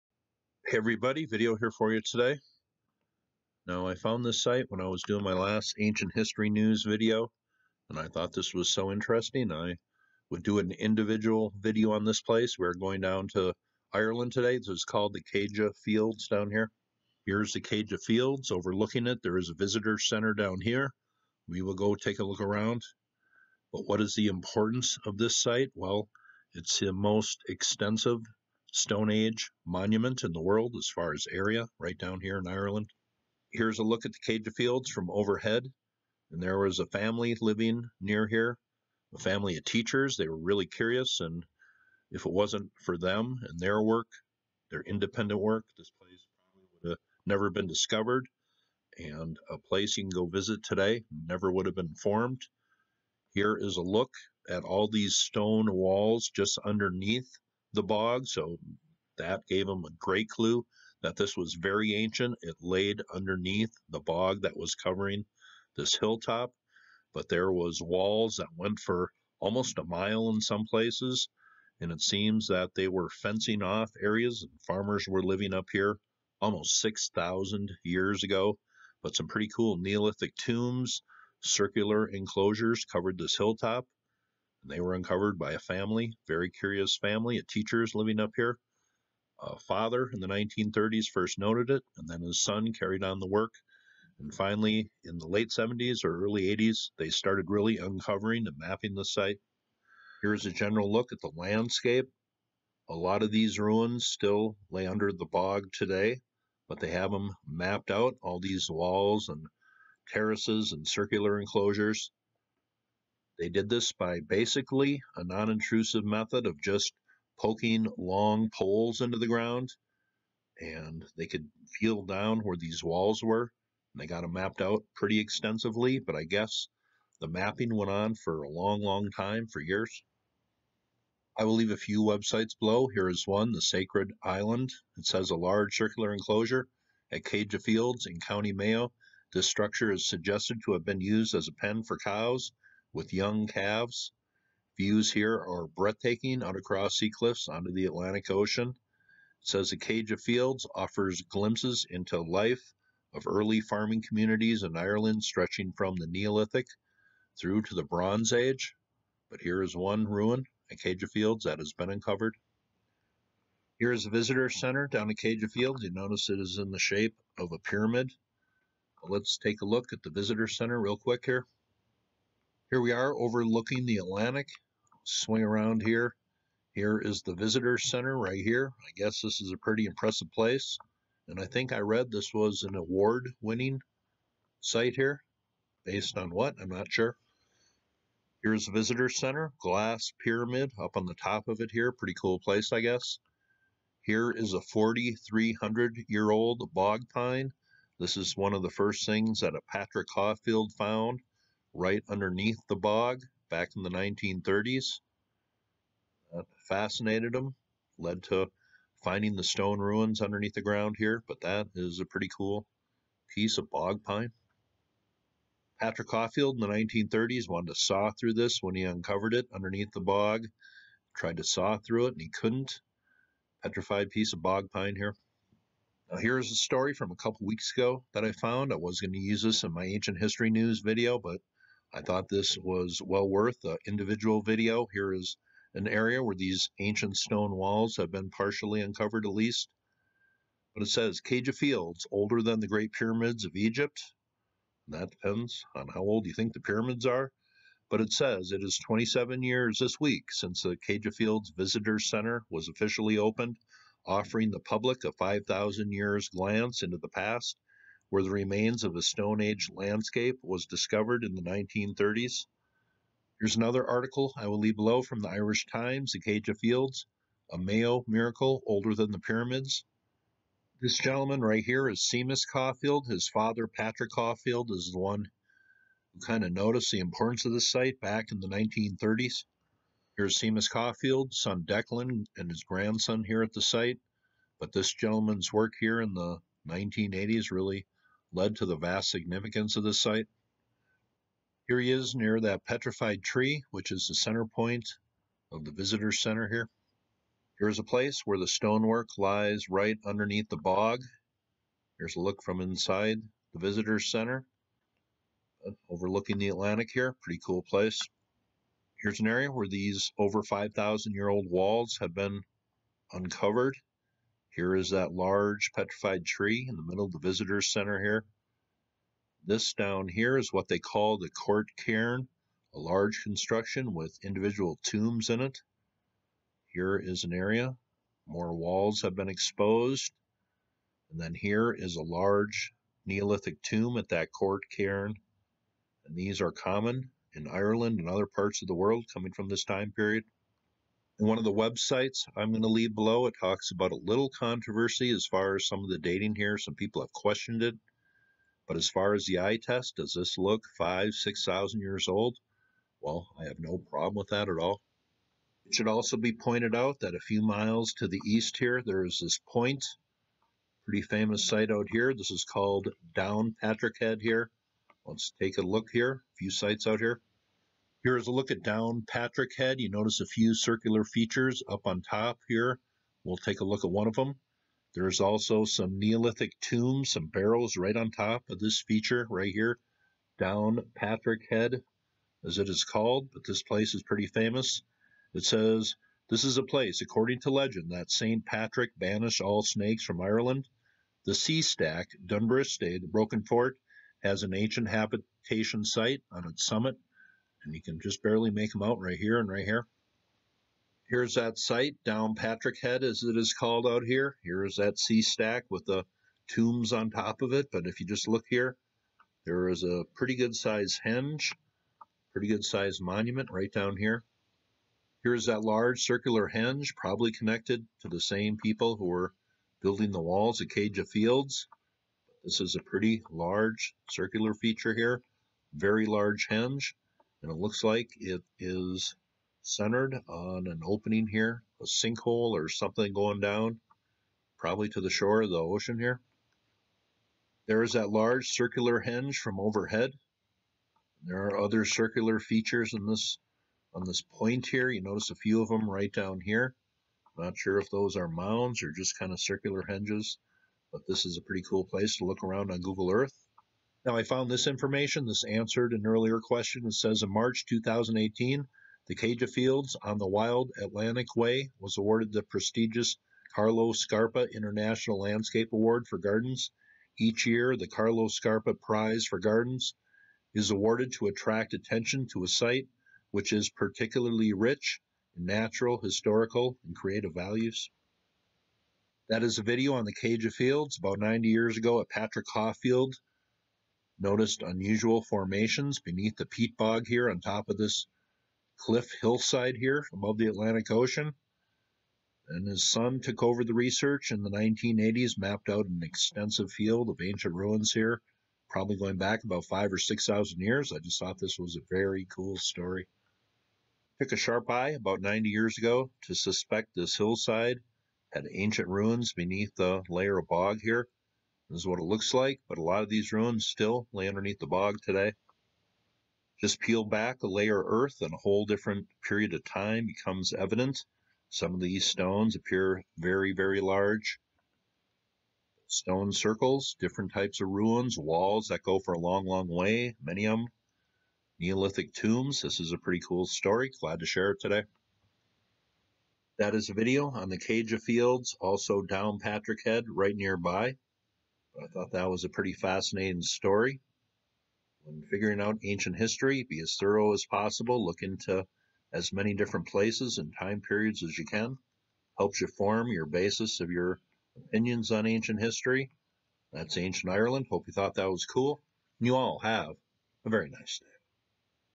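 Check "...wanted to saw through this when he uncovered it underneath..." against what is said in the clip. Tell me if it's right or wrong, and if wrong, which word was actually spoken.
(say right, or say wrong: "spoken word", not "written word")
right.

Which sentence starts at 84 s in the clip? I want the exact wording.
And they were uncovered by a family, very curious family, a teacher's living up here.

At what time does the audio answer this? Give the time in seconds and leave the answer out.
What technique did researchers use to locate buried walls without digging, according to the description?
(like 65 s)
117 s.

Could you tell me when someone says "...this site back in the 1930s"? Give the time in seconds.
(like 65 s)
277 s.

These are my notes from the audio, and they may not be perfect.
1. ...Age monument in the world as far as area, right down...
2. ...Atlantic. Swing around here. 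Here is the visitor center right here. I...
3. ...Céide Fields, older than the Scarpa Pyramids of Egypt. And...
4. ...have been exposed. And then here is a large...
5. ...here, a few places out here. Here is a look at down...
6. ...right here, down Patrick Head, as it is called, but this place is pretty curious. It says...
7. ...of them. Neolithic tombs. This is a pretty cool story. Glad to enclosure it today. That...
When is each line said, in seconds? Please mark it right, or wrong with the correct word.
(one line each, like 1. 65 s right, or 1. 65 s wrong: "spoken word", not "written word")
1. 29 s right
2. 173 s right
3. 241 s wrong: "Great", not "Scarpa"
4. 329 s right
5. 365 s wrong: "sites", not "places"
6. 379 s wrong: "famous", not "curious"
7. 530 s wrong: "share", not "enclosure".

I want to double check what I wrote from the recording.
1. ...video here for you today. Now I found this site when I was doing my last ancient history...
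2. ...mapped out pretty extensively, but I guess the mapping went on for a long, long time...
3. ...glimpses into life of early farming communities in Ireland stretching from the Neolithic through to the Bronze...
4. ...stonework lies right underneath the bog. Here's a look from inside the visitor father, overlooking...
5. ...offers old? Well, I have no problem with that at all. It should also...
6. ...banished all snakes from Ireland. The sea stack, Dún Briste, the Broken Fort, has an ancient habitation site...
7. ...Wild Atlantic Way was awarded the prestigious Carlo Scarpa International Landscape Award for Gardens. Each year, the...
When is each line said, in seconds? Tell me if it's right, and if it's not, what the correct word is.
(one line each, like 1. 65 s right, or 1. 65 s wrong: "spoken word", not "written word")
1. 1 s right
2. 124 s right
3. 151 s right
4. 298 s wrong: "center", not "father"
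5. 351 s wrong: "years", not "offers"
6. 388 s right
7. 460 s right.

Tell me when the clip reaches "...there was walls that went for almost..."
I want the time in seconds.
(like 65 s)
67 s.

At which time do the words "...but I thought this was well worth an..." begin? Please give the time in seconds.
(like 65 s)
231 s.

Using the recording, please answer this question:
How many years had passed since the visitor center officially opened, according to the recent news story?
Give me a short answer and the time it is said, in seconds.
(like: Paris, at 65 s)
27, at 248 s.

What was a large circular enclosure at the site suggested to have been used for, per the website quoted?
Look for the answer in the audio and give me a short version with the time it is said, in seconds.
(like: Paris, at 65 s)
A pen for cows with young calves, at 141 s.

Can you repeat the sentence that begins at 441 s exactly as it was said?
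There are other circular features in this on this point here.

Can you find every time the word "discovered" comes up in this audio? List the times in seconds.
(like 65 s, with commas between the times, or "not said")
47 s, 260 s.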